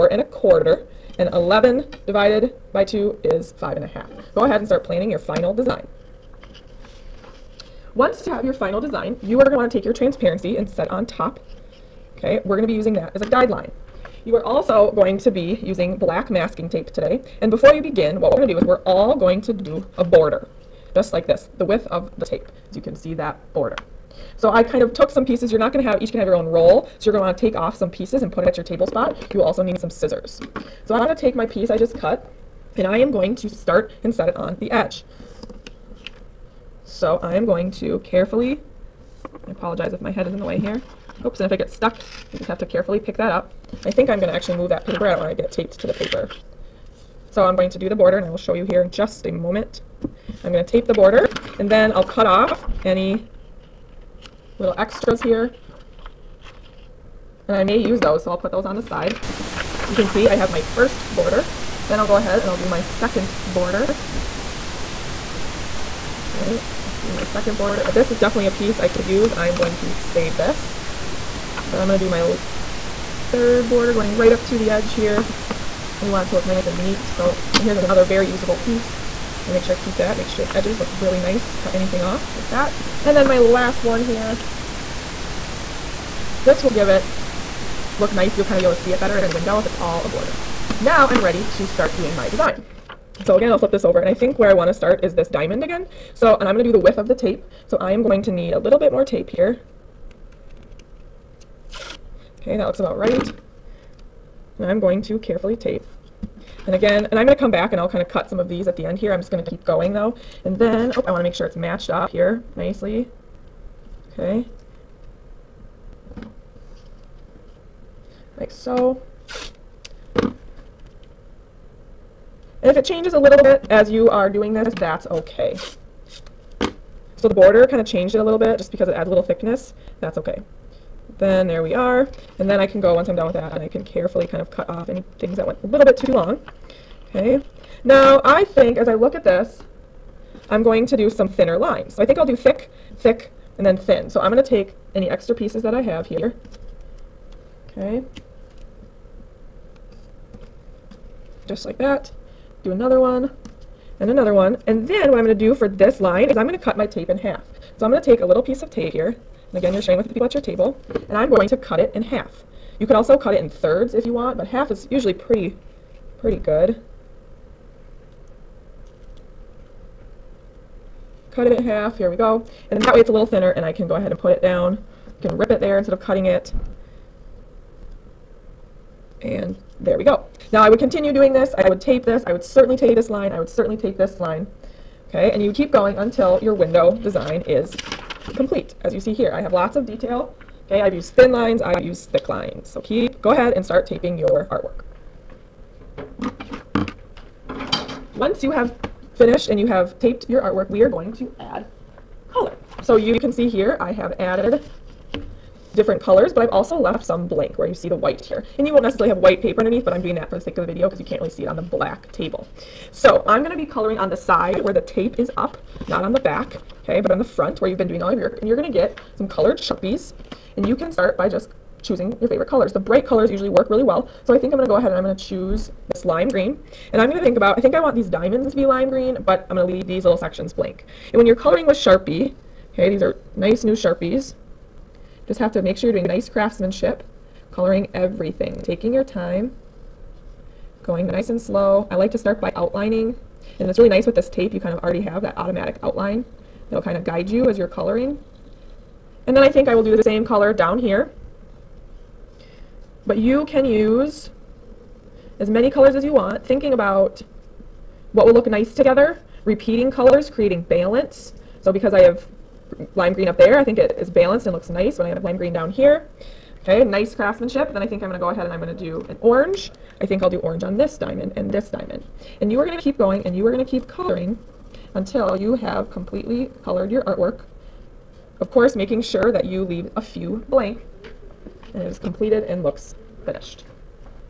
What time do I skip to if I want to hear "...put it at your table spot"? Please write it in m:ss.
0:28.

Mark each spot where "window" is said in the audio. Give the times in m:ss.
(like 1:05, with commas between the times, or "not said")
1:29, 3:06.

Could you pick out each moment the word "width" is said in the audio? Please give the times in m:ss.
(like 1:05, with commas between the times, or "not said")
0:21, 1:36.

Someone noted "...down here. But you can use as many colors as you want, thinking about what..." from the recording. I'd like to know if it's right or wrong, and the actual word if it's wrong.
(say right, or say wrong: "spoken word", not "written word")
right.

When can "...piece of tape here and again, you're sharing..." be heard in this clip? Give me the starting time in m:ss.
2:38.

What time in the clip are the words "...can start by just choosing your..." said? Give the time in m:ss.
3:40.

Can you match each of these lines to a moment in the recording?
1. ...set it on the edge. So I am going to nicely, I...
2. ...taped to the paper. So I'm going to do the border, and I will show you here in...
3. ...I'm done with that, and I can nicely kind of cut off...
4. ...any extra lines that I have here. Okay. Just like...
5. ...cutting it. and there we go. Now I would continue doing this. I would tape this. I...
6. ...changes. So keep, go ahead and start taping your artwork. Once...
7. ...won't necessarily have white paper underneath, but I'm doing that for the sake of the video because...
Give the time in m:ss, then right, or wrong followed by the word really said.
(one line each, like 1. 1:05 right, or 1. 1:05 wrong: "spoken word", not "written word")
1. 0:34 wrong: "carefully", not "nicely"
2. 0:45 right
3. 2:13 wrong: "carefully", not "nicely"
4. 2:24 wrong: "pieces", not "lines"
5. 2:56 right
6. 3:12 wrong: "lines", not "changes"
7. 3:28 right.